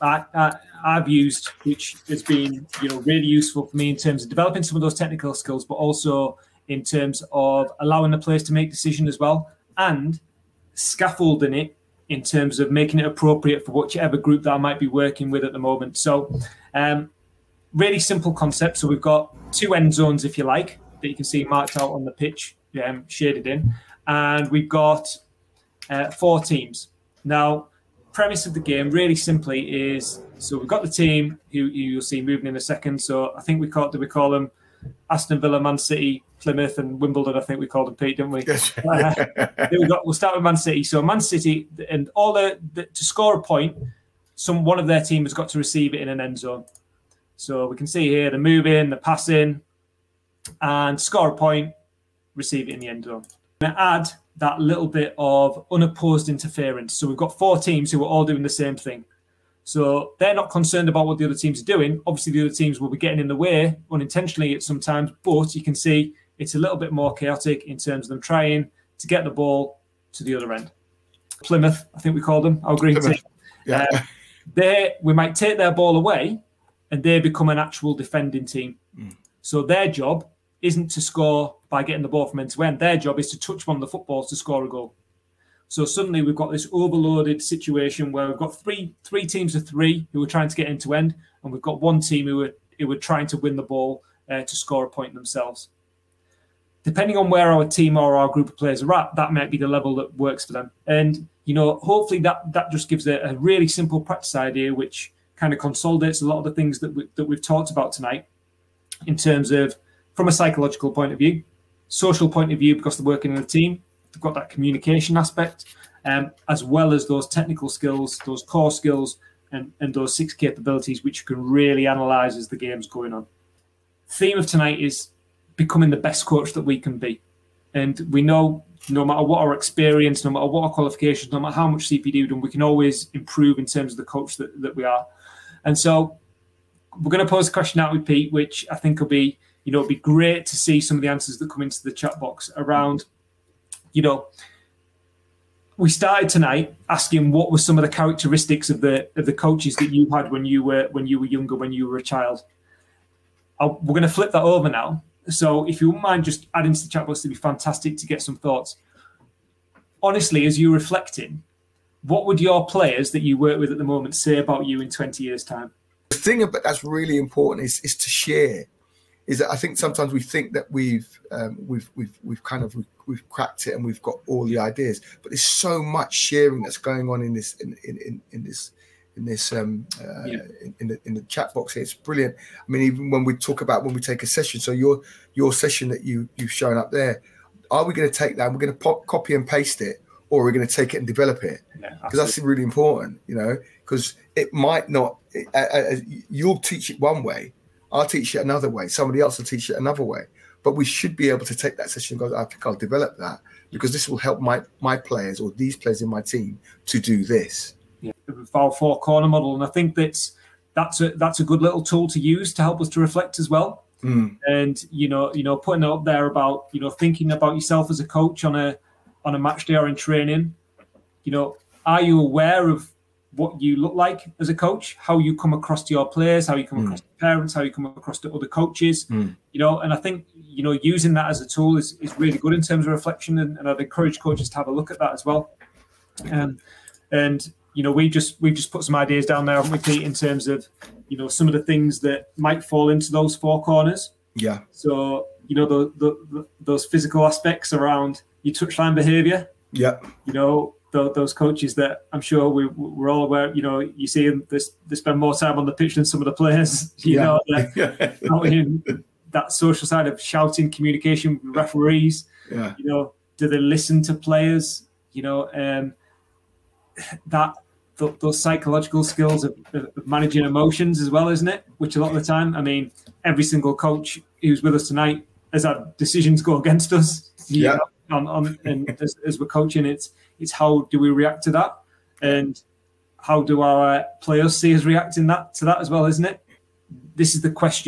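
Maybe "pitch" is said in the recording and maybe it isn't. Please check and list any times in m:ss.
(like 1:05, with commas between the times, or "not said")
0:22, 4:15.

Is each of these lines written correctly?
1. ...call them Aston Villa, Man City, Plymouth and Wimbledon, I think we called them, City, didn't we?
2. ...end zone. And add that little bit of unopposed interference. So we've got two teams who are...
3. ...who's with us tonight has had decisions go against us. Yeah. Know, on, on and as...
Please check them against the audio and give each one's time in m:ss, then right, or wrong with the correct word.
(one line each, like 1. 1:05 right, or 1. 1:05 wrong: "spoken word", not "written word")
1. 0:34 wrong: "Pete", not "City"
2. 0:52 wrong: "four", not "two"
3. 4:34 right.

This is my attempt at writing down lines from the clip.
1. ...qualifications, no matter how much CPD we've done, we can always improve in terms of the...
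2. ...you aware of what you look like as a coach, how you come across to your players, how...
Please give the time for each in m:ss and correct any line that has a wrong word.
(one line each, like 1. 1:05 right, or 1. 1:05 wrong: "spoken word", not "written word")
1. 2:10 right
2. 3:42 right.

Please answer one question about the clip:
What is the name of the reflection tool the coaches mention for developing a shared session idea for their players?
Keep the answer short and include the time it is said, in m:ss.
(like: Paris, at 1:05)
four corner model, at 3:28.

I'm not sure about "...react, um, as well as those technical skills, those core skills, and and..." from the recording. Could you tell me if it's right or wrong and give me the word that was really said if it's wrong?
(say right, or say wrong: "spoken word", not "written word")
wrong: "aspect", not "react".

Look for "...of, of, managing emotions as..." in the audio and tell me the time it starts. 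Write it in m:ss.
4:29.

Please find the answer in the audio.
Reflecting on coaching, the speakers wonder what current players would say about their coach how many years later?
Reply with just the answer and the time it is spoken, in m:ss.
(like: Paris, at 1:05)
20, at 2:44.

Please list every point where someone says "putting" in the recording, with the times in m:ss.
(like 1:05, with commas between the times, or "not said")
3:35.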